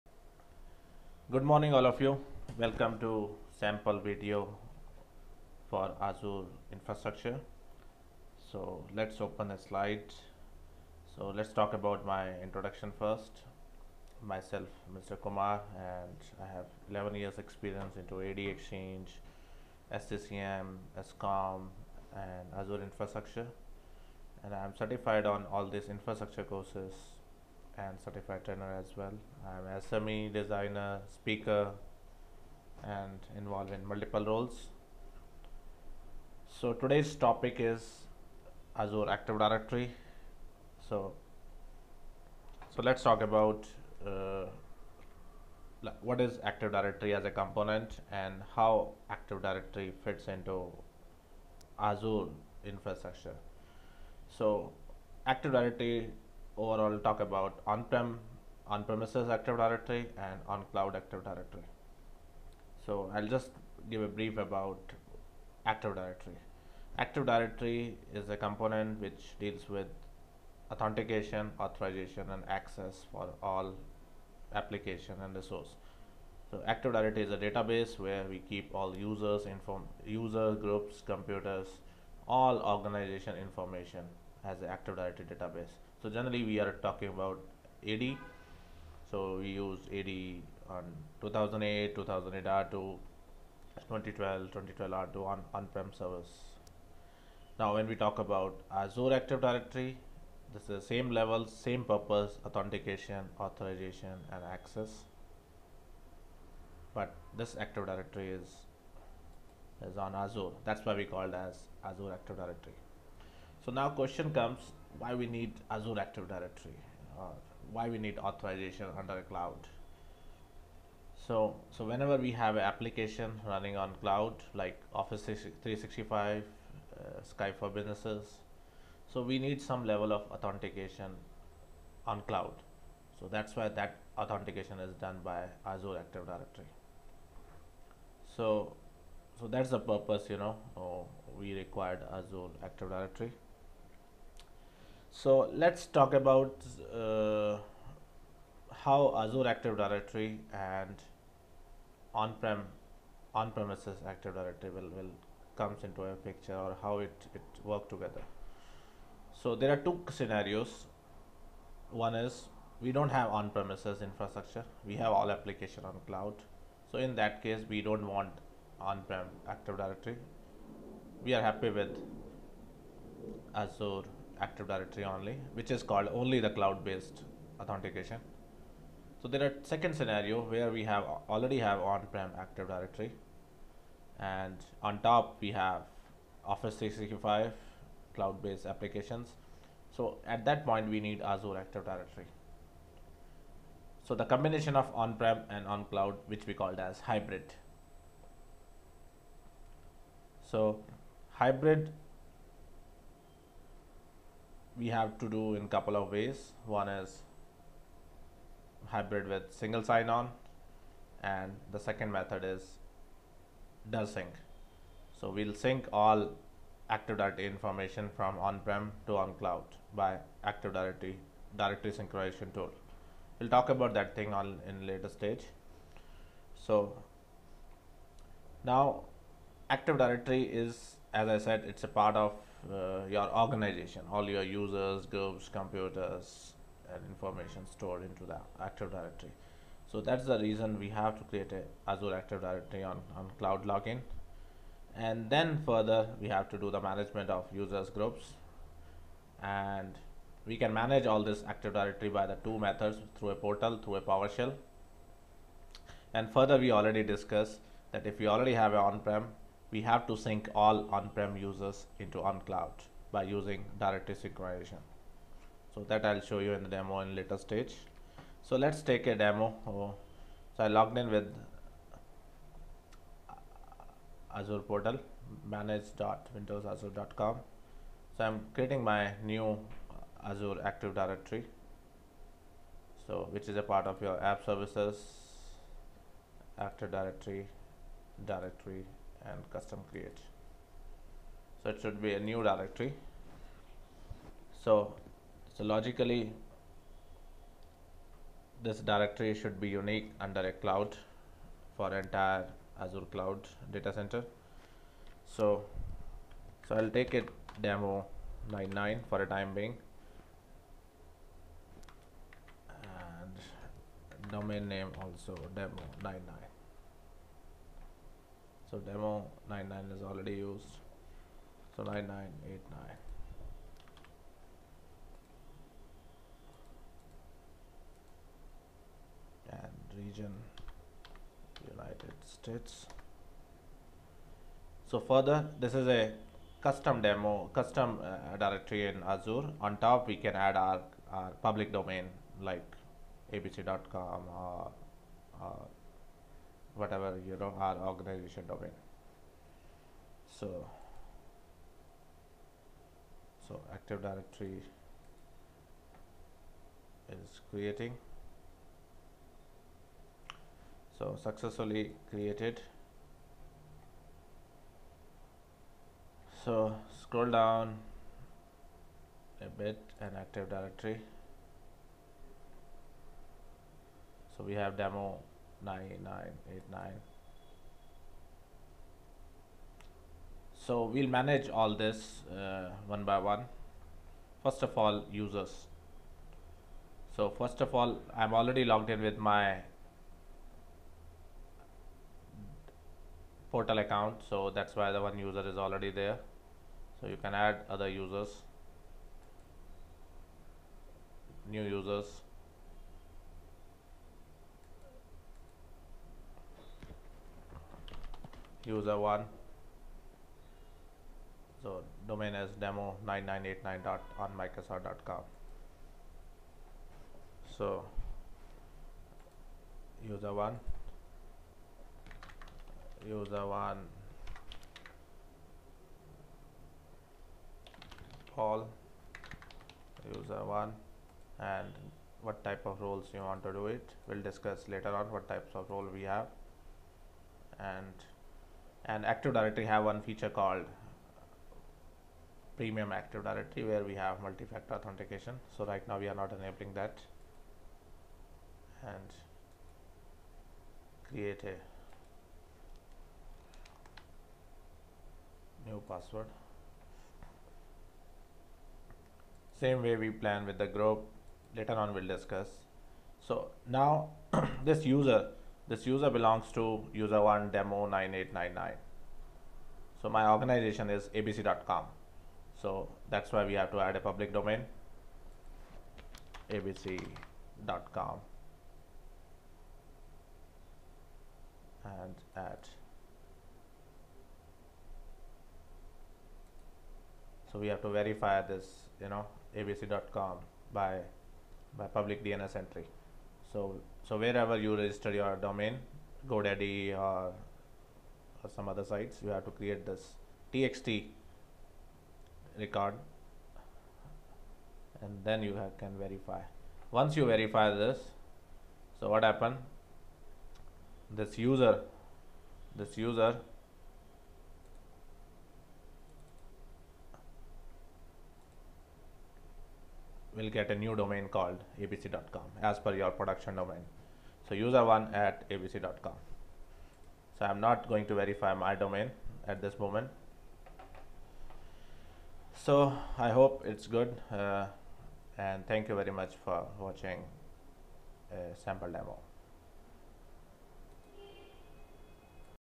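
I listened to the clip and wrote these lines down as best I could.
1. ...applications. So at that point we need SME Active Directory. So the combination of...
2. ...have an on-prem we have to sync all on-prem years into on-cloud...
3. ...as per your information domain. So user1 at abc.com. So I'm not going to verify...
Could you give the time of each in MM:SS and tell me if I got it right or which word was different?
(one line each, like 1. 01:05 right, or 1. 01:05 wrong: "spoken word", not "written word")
1. 03:08 wrong: "Azure", not "SME"
2. 04:18 wrong: "users", not "years"
3. 08:42 wrong: "production", not "information".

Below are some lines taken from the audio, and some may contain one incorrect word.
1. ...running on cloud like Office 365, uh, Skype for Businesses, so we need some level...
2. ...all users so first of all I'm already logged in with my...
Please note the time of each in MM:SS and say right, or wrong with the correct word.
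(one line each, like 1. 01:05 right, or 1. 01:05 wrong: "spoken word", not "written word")
1. 02:03 right
2. 06:24 right.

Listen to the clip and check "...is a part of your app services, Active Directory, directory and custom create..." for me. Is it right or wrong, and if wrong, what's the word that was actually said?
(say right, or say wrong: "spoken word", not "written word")
right.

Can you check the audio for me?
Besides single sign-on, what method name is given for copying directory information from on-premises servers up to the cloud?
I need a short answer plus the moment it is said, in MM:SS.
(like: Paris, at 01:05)
DirSync, at 03:33.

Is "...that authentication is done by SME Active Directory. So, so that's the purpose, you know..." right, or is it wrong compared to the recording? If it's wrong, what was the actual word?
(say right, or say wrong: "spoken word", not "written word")
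wrong: "Azure", not "SME".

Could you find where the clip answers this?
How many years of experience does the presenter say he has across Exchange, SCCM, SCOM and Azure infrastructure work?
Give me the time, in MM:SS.
00:16.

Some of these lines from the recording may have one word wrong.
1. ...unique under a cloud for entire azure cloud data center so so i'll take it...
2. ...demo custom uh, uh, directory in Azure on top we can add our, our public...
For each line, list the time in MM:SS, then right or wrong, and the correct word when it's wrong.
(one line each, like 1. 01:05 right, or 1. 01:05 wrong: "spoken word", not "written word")
1. 04:59 right
2. 05:37 right.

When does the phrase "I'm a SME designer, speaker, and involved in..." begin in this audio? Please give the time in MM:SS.
00:29.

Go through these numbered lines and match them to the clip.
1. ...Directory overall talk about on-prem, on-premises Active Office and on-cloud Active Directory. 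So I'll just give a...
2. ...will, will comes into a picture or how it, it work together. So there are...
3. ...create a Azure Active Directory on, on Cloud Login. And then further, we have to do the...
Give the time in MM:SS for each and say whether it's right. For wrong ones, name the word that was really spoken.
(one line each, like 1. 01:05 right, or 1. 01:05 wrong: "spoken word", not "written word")
1. 00:55 wrong: "Directory", not "Office"
2. 02:34 right
3. 04:01 right.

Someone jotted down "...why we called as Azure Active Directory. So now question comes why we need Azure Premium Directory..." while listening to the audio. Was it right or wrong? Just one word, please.
wrong.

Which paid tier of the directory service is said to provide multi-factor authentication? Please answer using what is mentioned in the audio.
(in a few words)
Premium Active Directory.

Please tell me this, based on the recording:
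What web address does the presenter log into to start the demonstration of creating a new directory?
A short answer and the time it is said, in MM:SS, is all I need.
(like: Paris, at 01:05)
manage.windowsazure.com, at 04:35.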